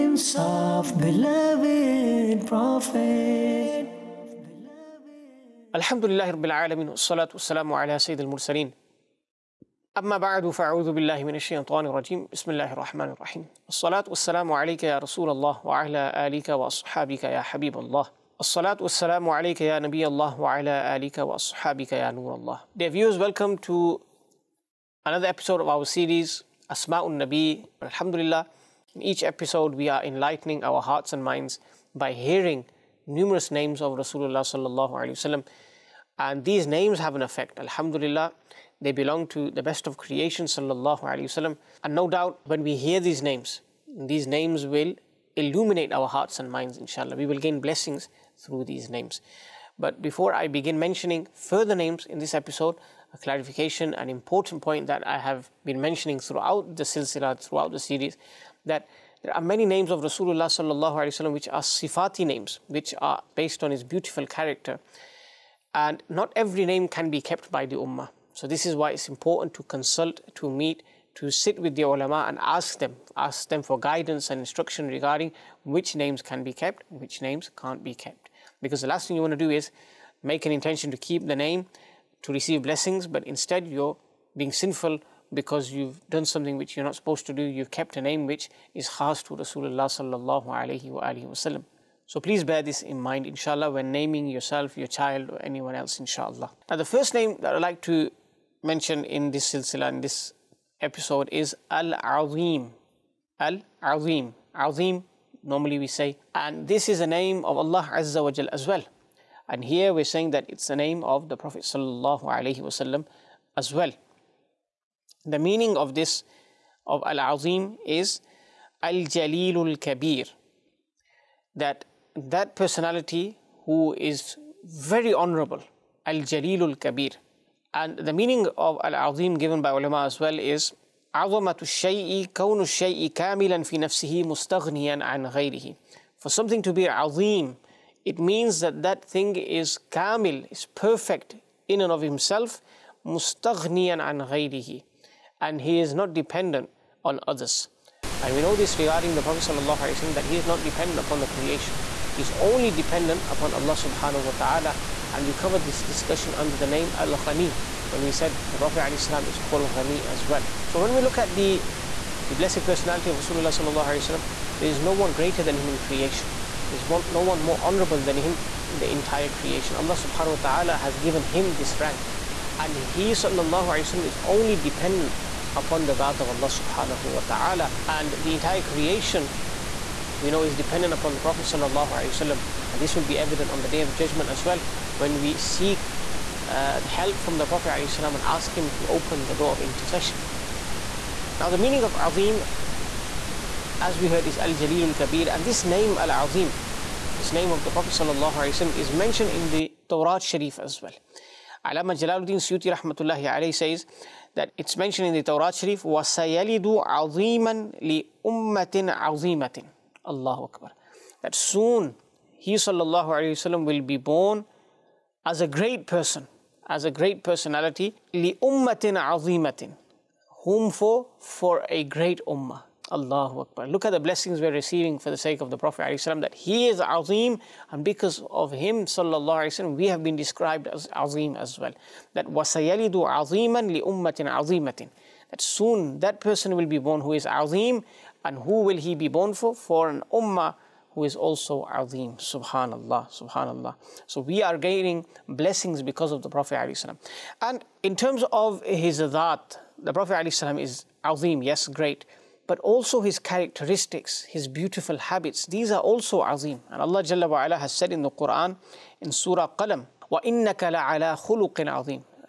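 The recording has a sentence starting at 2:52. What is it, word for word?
And he sallallahu is only dependent upon the Dhat of Allah subhanahu wa ta'ala.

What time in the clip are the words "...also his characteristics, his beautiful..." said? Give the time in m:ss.
4:12.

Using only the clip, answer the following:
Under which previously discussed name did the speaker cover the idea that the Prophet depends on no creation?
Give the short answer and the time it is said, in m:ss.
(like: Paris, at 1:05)
Al Ghani, at 2:36.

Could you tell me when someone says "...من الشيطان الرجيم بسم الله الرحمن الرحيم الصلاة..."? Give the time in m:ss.
0:11.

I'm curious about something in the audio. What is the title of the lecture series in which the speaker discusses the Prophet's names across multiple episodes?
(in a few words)
Asma'un Nabi.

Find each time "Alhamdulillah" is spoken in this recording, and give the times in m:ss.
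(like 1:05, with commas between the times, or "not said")
0:27, 0:37.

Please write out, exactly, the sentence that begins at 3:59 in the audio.
For an Ummah who is also Azim.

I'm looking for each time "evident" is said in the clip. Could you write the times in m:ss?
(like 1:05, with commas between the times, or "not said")
3:03.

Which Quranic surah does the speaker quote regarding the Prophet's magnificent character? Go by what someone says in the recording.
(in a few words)
Surah Qalam.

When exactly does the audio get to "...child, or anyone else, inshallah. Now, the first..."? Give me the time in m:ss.
1:34.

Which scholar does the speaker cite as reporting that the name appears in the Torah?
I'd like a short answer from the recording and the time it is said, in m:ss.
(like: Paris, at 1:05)
Jalaluddin Suyuti, at 3:21.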